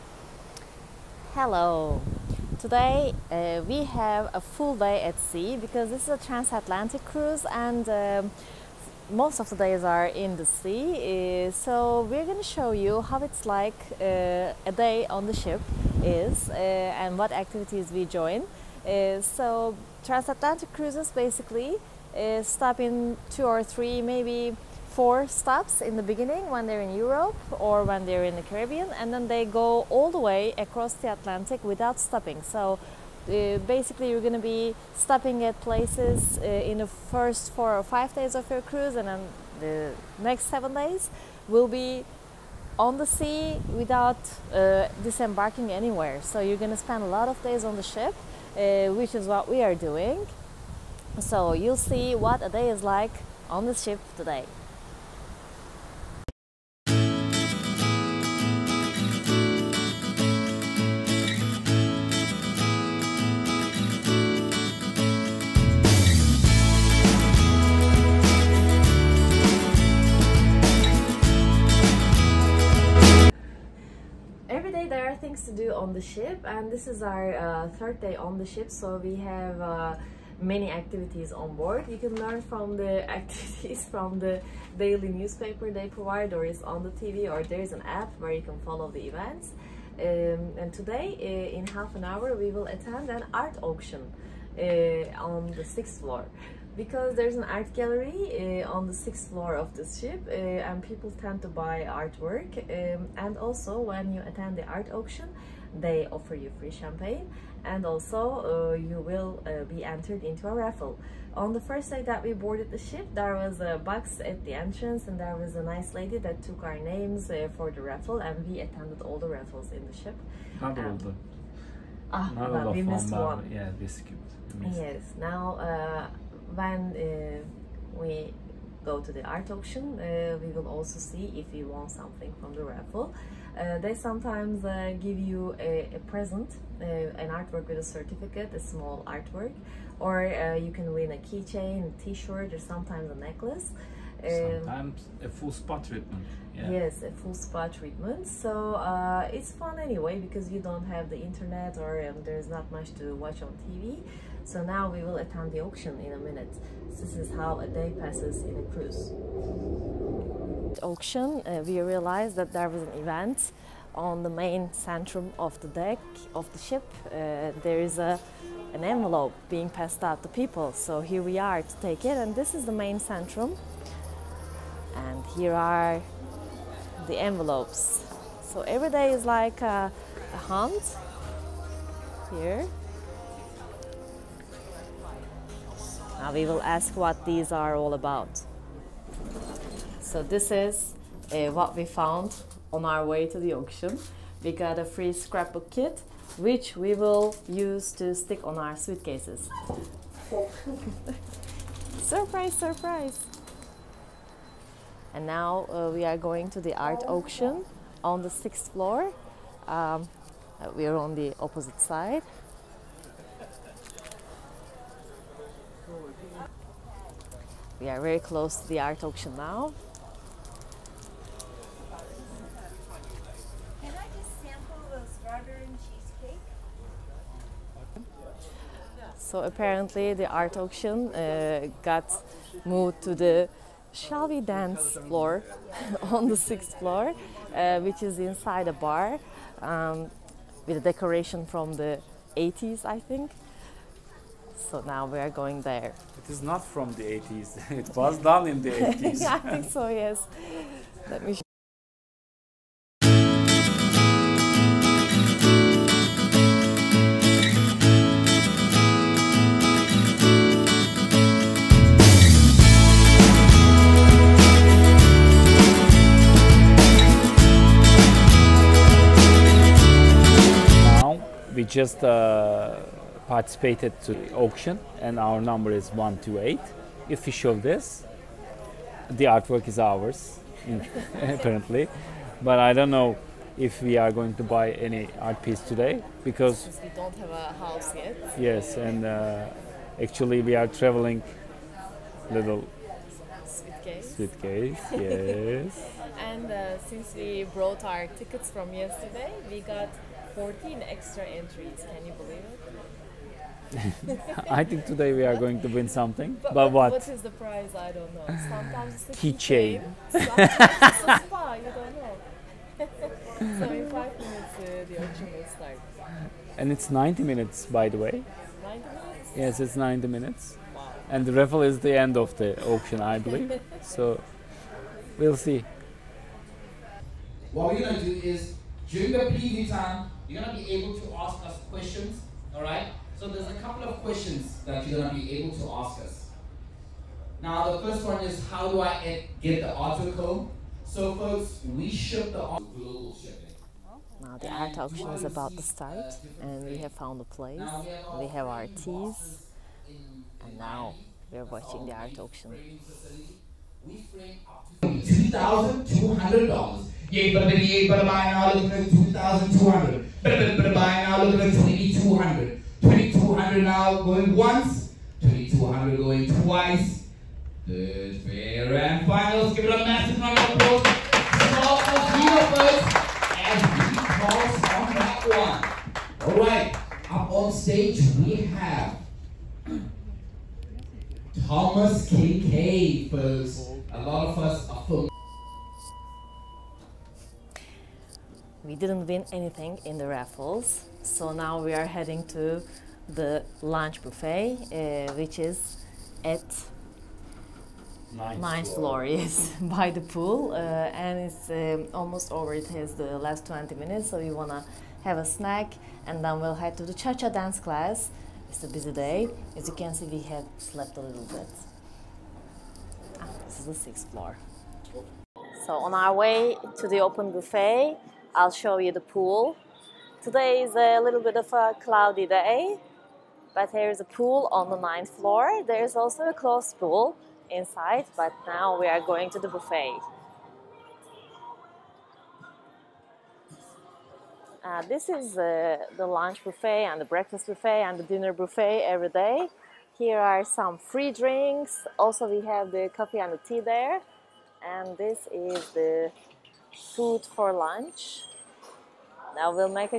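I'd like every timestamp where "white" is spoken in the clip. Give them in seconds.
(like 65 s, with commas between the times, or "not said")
not said.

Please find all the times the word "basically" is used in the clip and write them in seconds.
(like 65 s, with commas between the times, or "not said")
21 s, 33 s.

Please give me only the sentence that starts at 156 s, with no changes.
This is how a day passes in a cruise.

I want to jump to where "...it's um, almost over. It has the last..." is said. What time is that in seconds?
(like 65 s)
401 s.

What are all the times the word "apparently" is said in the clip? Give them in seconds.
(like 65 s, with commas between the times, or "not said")
229 s, 281 s.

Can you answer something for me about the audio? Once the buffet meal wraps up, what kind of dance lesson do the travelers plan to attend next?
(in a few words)
cha-cha.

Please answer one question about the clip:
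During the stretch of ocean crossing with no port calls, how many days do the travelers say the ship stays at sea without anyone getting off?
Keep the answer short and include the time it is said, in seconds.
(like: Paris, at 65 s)
7, at 40 s.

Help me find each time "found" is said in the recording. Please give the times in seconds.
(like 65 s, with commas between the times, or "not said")
191 s, 346 s.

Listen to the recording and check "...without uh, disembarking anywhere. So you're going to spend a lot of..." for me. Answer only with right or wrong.
right.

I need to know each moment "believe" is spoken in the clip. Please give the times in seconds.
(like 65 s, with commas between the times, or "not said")
302 s, 323 s.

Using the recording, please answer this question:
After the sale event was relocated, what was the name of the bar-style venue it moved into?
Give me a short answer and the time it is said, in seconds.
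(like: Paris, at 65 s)
Shall We Dance, at 233 s.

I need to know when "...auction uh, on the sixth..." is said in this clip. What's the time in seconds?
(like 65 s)
93 s.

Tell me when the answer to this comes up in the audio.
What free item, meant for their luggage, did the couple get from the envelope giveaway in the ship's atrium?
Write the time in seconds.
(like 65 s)
195 s.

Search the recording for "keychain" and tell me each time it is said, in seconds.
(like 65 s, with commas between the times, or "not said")
141 s, 309 s.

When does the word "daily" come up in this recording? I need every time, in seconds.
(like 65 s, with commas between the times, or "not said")
84 s.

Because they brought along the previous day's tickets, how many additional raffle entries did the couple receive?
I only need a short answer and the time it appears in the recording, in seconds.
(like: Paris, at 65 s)
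14, at 300 s.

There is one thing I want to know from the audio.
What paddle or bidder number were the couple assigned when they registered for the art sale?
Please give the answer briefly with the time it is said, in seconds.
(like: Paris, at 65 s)
128, at 275 s.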